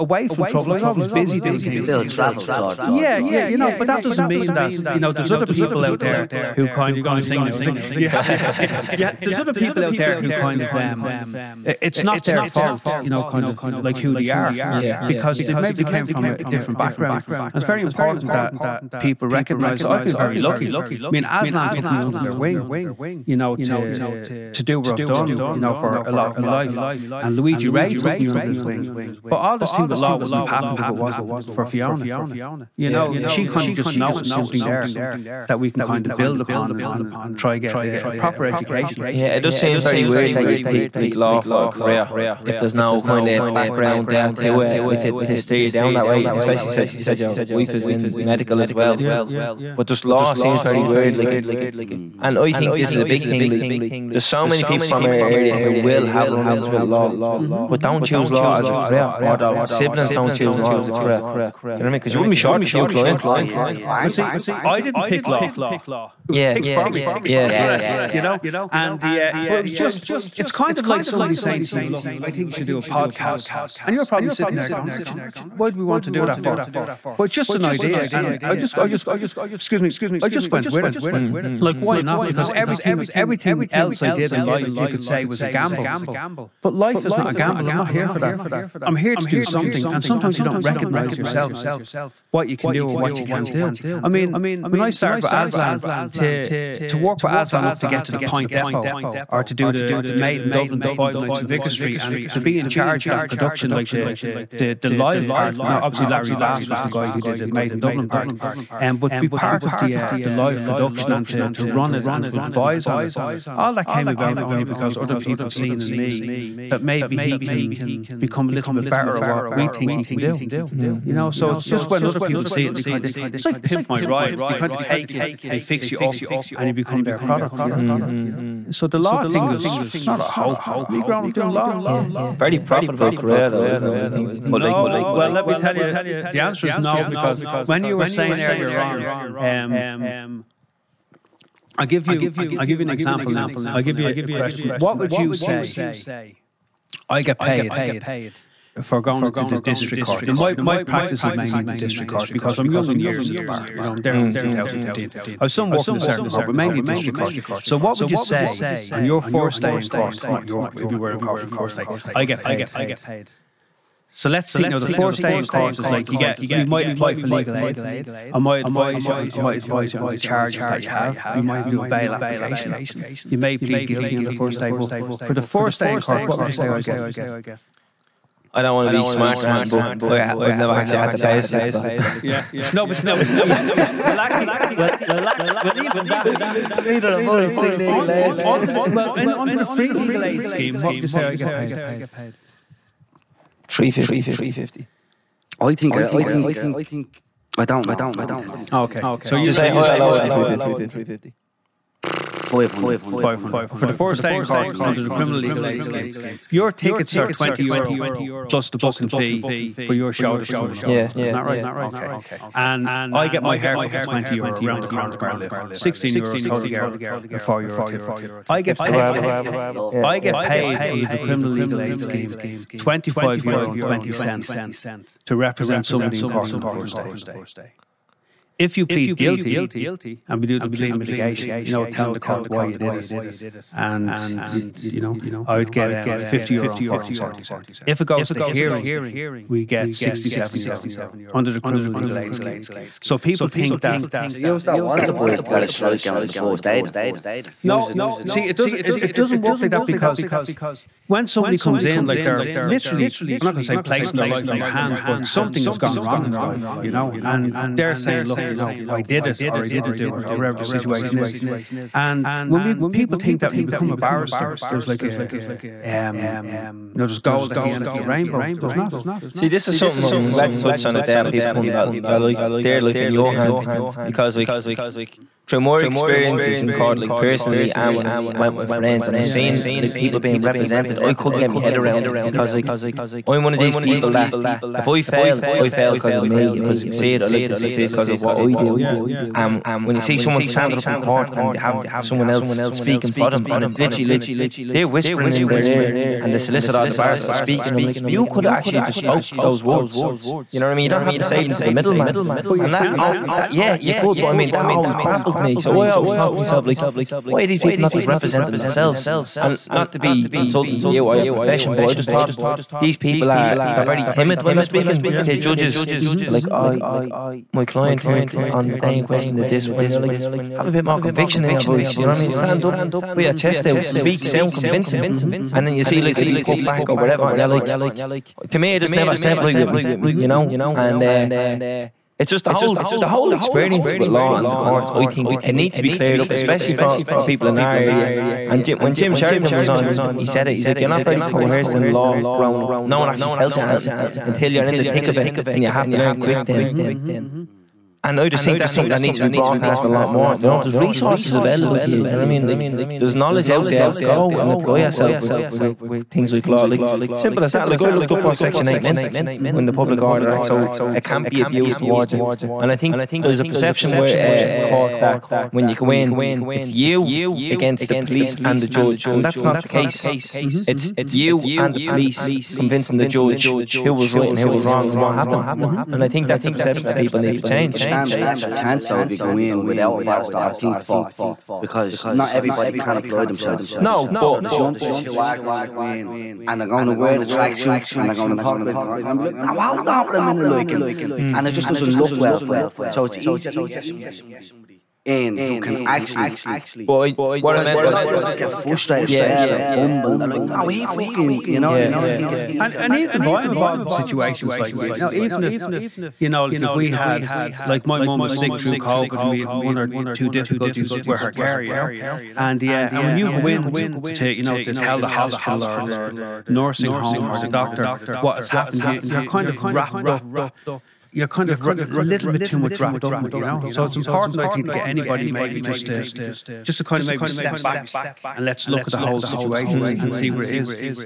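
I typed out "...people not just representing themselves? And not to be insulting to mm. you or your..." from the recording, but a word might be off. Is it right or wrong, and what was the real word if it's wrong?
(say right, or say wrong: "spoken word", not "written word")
right.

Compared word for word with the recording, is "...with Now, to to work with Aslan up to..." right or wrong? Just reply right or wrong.
wrong.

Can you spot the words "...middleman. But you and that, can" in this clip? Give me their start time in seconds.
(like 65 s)
301 s.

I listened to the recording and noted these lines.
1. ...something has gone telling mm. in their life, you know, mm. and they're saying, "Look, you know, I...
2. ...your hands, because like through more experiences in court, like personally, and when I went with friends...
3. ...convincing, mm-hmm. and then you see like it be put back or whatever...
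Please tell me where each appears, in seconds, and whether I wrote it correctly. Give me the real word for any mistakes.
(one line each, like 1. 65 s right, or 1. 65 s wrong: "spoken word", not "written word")
1. 255 s wrong: "wrong", not "telling"
2. 273 s right
3. 324 s right.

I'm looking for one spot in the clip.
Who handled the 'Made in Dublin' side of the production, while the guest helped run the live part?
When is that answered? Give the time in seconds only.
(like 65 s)
106 s.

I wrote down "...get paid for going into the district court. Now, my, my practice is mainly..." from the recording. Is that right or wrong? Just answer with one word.
right.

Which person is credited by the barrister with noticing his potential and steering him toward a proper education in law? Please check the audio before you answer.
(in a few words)
Fiona.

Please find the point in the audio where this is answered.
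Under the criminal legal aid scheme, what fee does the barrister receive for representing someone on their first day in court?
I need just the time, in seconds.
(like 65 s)
222 s.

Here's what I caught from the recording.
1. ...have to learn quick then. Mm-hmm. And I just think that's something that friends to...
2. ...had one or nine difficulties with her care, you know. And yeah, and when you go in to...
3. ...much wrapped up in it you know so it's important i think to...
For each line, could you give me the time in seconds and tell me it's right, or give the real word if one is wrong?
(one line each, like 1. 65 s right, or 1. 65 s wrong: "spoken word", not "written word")
1. 345 s wrong: "needs", not "friends"
2. 409 s wrong: "two", not "nine"
3. 422 s right.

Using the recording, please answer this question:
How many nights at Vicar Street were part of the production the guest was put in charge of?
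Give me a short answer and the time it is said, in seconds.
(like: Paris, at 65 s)
5, at 100 s.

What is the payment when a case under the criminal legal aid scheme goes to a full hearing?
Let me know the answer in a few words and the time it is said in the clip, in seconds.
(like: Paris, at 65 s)
67 euro, at 239 s.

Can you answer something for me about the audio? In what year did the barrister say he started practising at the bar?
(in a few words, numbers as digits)
2015.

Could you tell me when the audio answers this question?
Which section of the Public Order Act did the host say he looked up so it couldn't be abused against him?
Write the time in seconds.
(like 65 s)
358 s.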